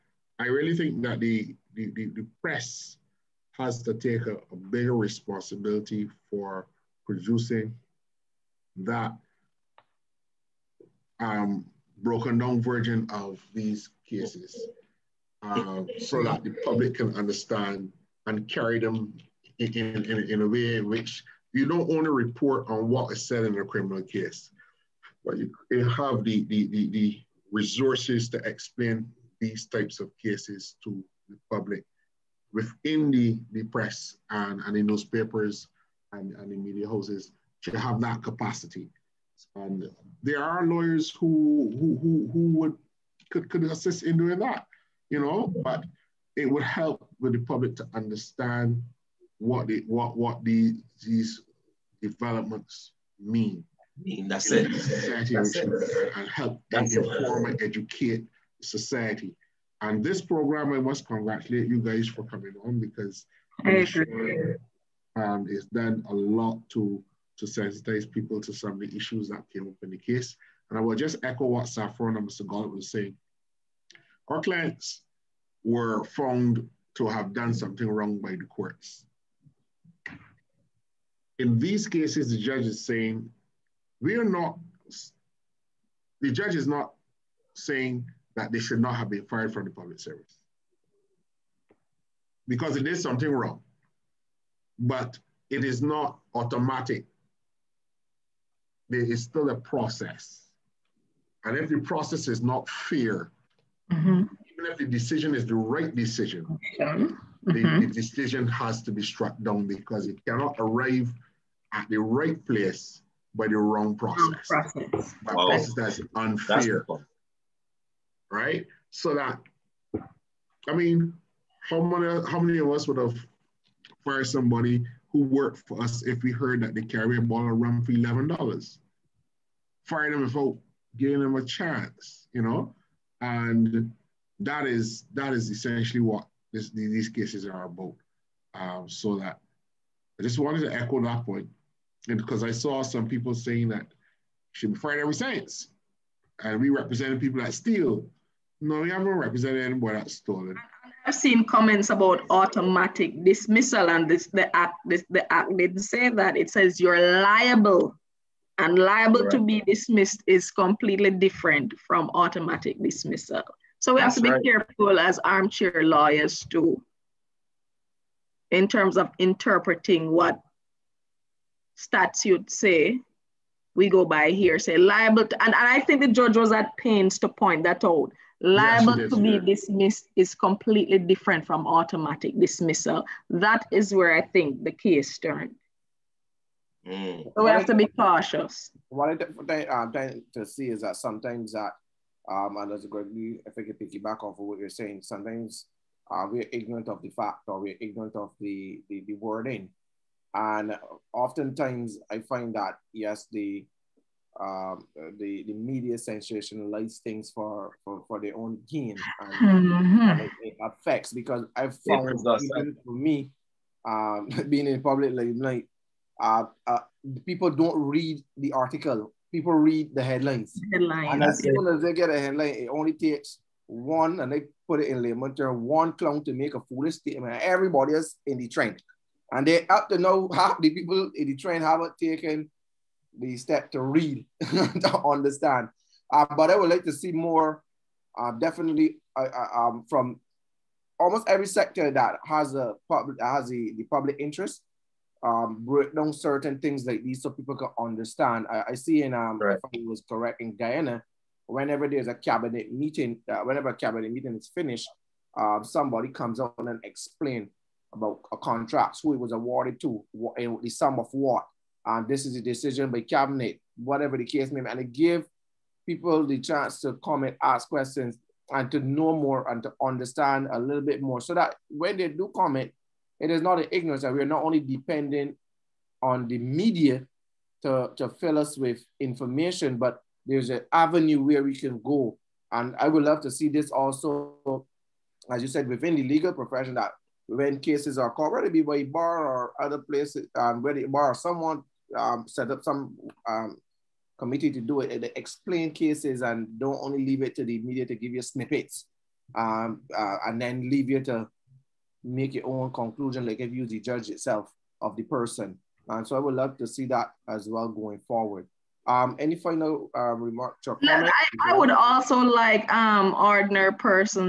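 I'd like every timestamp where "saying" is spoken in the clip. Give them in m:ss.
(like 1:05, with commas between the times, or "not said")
1:12, 1:22, 1:27, 2:23, 3:14.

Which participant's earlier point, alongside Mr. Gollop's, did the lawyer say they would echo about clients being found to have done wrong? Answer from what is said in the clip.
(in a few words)
Saffron.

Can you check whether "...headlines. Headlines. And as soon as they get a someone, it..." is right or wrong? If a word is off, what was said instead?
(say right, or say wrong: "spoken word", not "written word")
wrong: "headline", not "someone".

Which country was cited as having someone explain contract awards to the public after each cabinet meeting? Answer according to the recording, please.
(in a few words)
Guyana.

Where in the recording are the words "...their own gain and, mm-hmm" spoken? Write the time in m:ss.
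3:28.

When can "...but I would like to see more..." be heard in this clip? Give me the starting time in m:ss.
3:56.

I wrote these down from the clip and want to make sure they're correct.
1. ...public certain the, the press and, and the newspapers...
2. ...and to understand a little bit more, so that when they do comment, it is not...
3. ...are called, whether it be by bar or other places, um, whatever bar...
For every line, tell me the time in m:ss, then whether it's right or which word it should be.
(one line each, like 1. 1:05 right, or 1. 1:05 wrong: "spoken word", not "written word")
1. 0:31 wrong: "within", not "certain"
2. 4:29 right
3. 4:47 wrong: "whether", not "whatever".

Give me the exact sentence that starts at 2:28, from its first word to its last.
No, we haven't represented anyone that stolen.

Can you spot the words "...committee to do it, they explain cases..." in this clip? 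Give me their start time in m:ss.
4:54.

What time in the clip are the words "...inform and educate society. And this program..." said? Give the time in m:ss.
0:56.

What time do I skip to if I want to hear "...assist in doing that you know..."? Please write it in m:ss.
0:43.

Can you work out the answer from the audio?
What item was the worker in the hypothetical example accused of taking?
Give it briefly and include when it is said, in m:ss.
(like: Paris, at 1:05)
a ball rum, at 2:07.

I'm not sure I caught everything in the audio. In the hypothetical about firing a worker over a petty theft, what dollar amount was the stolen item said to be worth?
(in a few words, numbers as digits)
$11.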